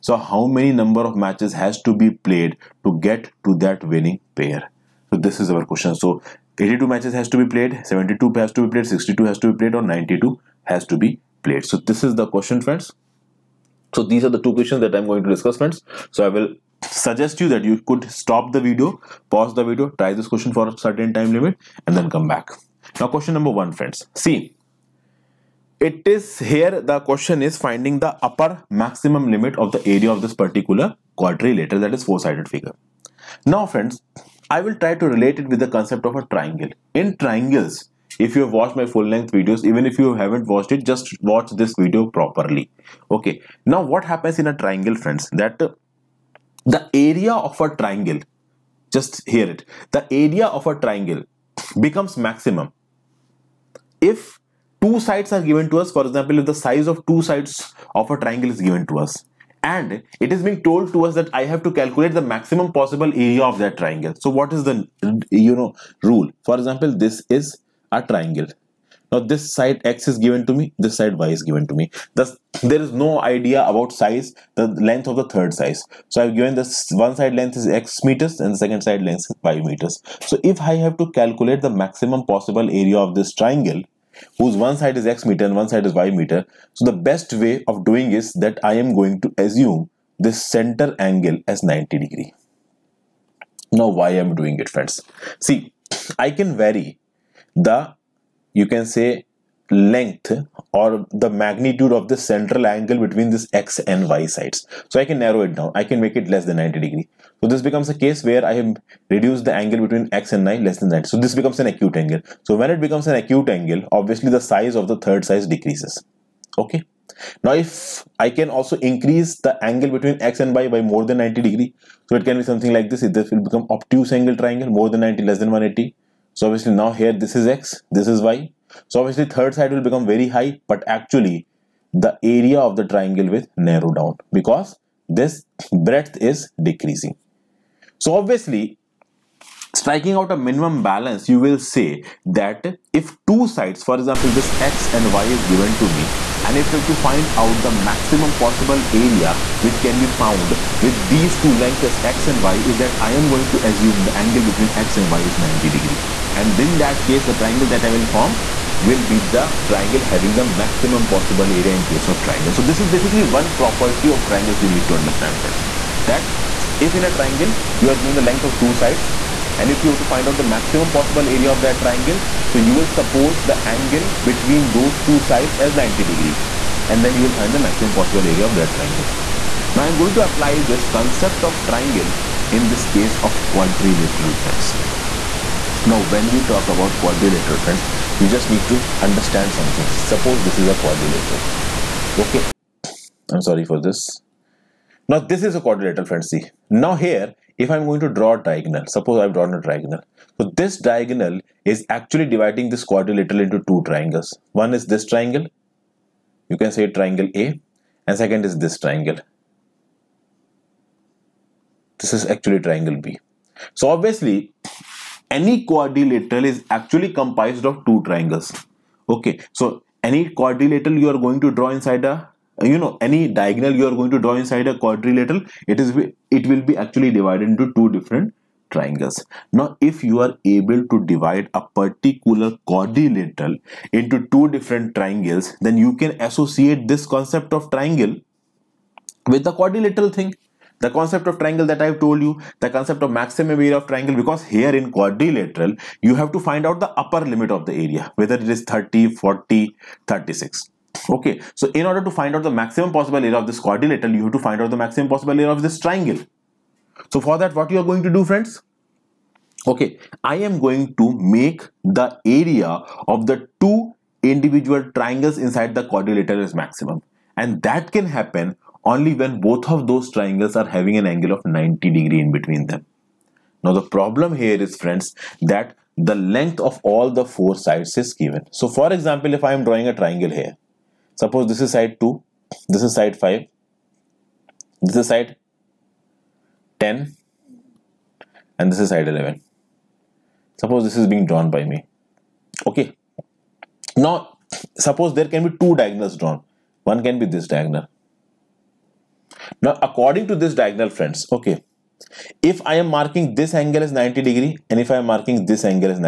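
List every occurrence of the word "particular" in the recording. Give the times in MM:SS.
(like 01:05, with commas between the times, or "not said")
00:30, 03:51.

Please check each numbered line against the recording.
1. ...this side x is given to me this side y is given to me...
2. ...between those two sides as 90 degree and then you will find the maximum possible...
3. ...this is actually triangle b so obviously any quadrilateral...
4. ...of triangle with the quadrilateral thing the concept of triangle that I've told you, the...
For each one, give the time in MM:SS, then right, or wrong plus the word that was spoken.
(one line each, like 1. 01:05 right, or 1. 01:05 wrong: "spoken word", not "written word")
1. 01:09 right
2. 02:54 right
3. 03:31 right
4. 03:57 right.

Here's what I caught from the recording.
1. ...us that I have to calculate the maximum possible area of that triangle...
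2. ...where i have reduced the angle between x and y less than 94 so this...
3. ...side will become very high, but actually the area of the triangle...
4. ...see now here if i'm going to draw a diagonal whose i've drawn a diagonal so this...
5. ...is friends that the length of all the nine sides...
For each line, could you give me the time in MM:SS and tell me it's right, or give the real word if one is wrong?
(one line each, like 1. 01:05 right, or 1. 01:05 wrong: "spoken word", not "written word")
1. 01:01 right
2. 01:48 wrong: "90", not "94"
3. 02:09 right
4. 03:16 wrong: "suppose", not "whose"
5. 04:34 wrong: "four", not "nine".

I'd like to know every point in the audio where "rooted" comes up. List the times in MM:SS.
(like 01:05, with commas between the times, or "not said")
not said.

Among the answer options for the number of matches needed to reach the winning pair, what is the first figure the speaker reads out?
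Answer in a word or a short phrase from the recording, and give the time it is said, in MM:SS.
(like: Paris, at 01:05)
82, at 00:06.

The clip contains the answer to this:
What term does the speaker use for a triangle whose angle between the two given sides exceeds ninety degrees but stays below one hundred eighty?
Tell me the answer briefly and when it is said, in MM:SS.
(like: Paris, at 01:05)
obtuse angle triangle, at 02:03.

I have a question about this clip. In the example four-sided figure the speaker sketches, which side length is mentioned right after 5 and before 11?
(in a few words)
10.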